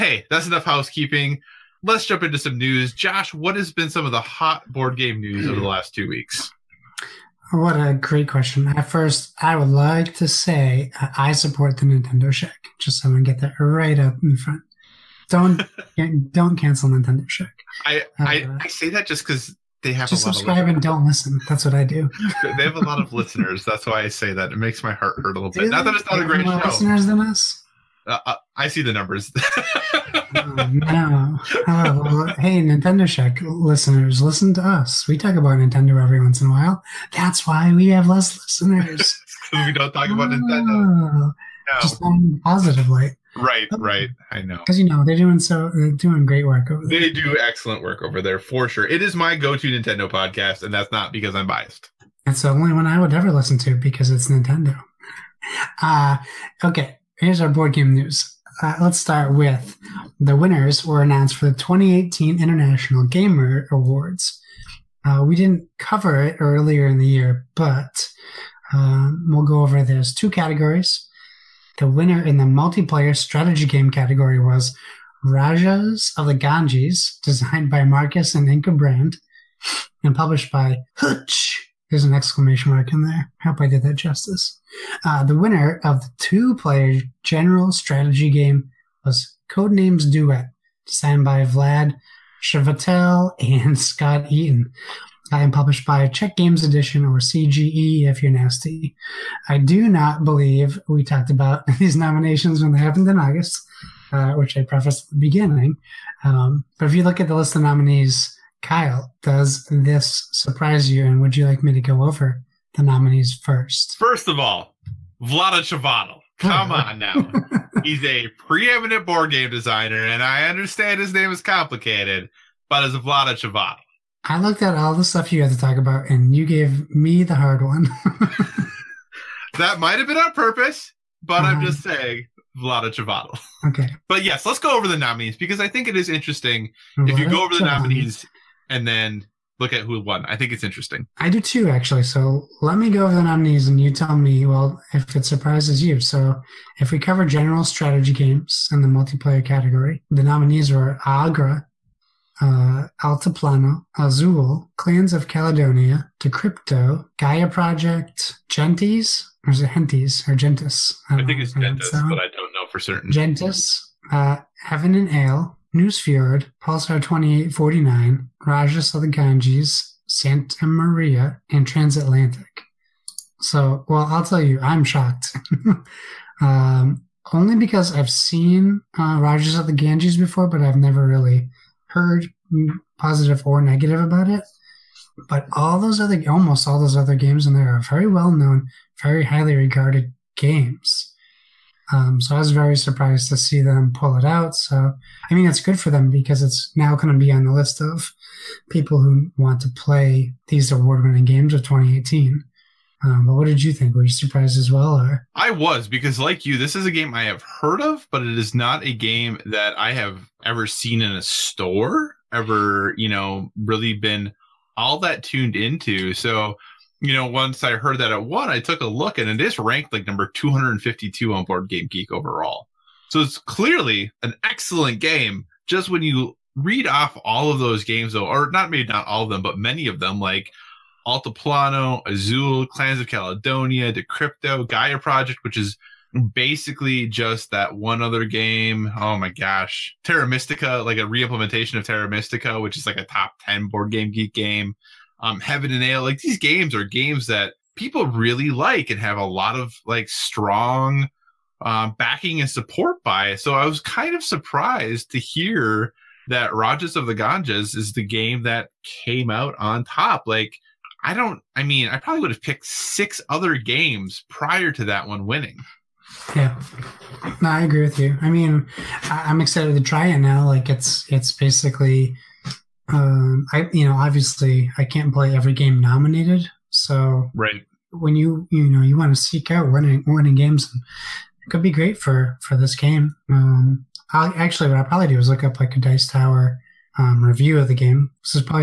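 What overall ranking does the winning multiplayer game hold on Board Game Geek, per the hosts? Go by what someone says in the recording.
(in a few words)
252.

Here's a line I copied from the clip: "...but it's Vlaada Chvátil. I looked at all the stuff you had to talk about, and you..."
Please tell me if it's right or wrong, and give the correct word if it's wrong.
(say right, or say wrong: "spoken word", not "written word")
right.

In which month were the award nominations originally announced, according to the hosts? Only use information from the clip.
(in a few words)
August.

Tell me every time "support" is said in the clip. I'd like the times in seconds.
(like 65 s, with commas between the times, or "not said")
11 s, 252 s.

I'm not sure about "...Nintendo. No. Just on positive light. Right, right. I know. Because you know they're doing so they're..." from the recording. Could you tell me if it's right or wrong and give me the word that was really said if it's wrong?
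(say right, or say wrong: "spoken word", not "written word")
right.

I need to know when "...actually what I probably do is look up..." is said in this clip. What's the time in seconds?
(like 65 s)
284 s.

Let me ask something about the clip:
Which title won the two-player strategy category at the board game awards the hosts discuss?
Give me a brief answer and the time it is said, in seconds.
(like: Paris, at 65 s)
Codenames Duet, at 89 s.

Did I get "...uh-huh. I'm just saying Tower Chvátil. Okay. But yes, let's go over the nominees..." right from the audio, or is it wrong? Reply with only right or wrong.
wrong.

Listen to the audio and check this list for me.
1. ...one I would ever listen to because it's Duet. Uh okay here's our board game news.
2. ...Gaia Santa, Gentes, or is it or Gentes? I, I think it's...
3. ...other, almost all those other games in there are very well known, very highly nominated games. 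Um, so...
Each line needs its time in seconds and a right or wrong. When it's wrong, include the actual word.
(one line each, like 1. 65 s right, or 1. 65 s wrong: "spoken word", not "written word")
1. 52 s wrong: "Nintendo", not "Duet"
2. 157 s wrong: "Project", not "Santa"
3. 185 s wrong: "regarded", not "nominated".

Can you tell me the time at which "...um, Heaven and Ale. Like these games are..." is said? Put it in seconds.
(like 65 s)
245 s.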